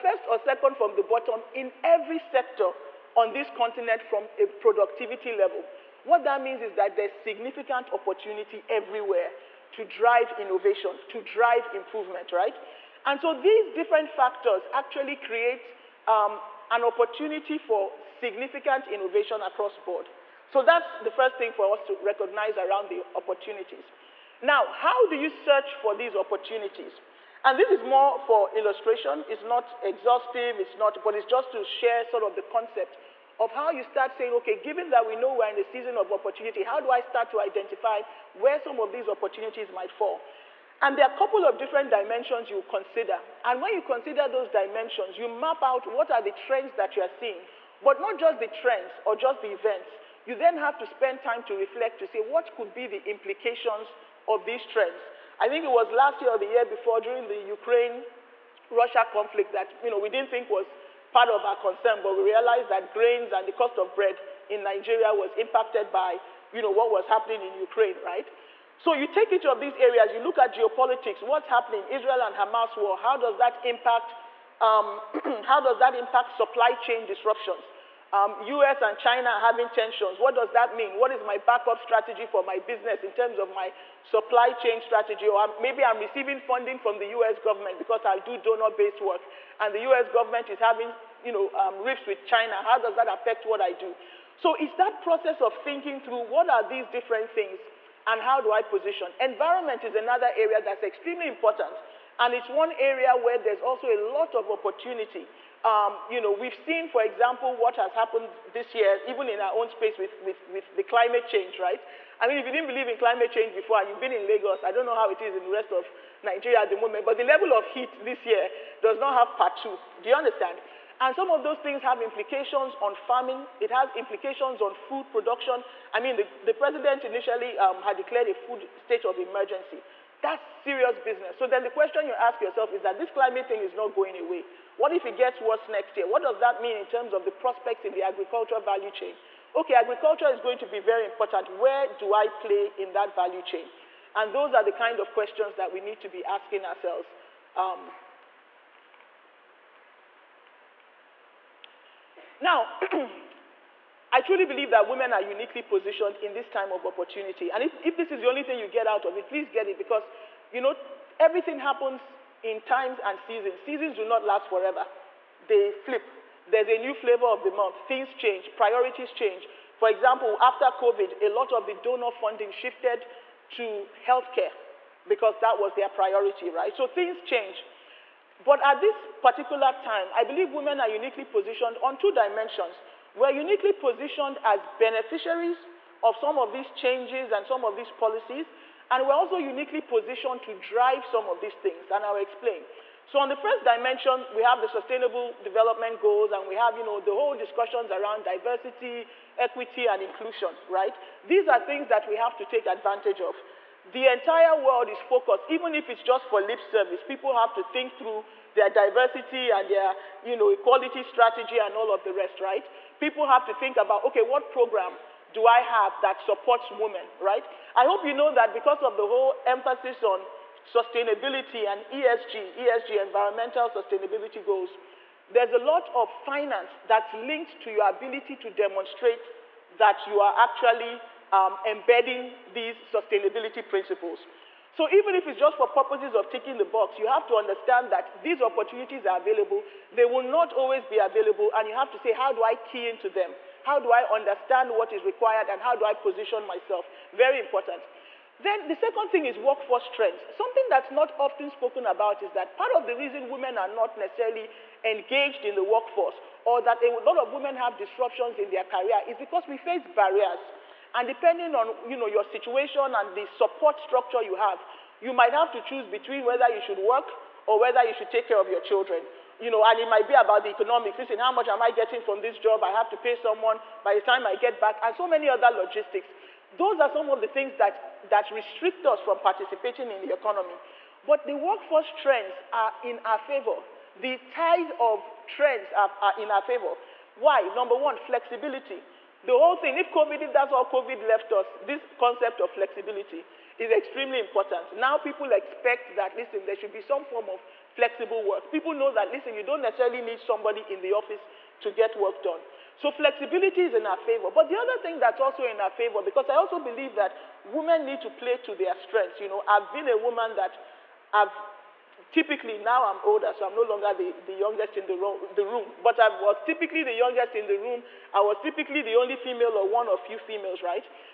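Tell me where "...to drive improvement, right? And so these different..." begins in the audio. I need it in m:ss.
0:11.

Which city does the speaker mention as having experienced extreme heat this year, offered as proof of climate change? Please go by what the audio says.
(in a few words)
Lagos.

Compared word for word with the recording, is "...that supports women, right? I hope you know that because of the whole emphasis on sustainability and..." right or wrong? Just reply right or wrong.
right.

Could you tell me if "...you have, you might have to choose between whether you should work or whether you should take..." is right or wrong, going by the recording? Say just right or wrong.
right.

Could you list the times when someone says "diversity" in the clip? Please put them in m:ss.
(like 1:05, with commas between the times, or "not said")
3:18, 3:28.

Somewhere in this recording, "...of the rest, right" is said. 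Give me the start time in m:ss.
3:31.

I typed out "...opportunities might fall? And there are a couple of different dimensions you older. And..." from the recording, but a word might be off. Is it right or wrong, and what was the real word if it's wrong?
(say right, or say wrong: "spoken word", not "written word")
wrong: "consider", not "older".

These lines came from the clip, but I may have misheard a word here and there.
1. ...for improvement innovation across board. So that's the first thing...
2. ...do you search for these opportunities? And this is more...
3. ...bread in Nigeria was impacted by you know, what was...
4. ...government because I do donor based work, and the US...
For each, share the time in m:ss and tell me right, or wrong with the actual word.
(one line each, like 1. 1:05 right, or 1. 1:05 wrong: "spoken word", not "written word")
1. 0:17 wrong: "significant", not "improvement"
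2. 0:25 right
3. 1:03 right
4. 1:27 right.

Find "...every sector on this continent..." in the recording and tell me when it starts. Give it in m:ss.
0:01.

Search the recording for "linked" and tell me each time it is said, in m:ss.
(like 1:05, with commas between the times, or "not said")
3:47.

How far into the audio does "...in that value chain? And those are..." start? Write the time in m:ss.
2:22.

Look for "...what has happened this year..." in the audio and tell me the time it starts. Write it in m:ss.
1:47.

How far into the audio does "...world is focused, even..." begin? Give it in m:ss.
3:24.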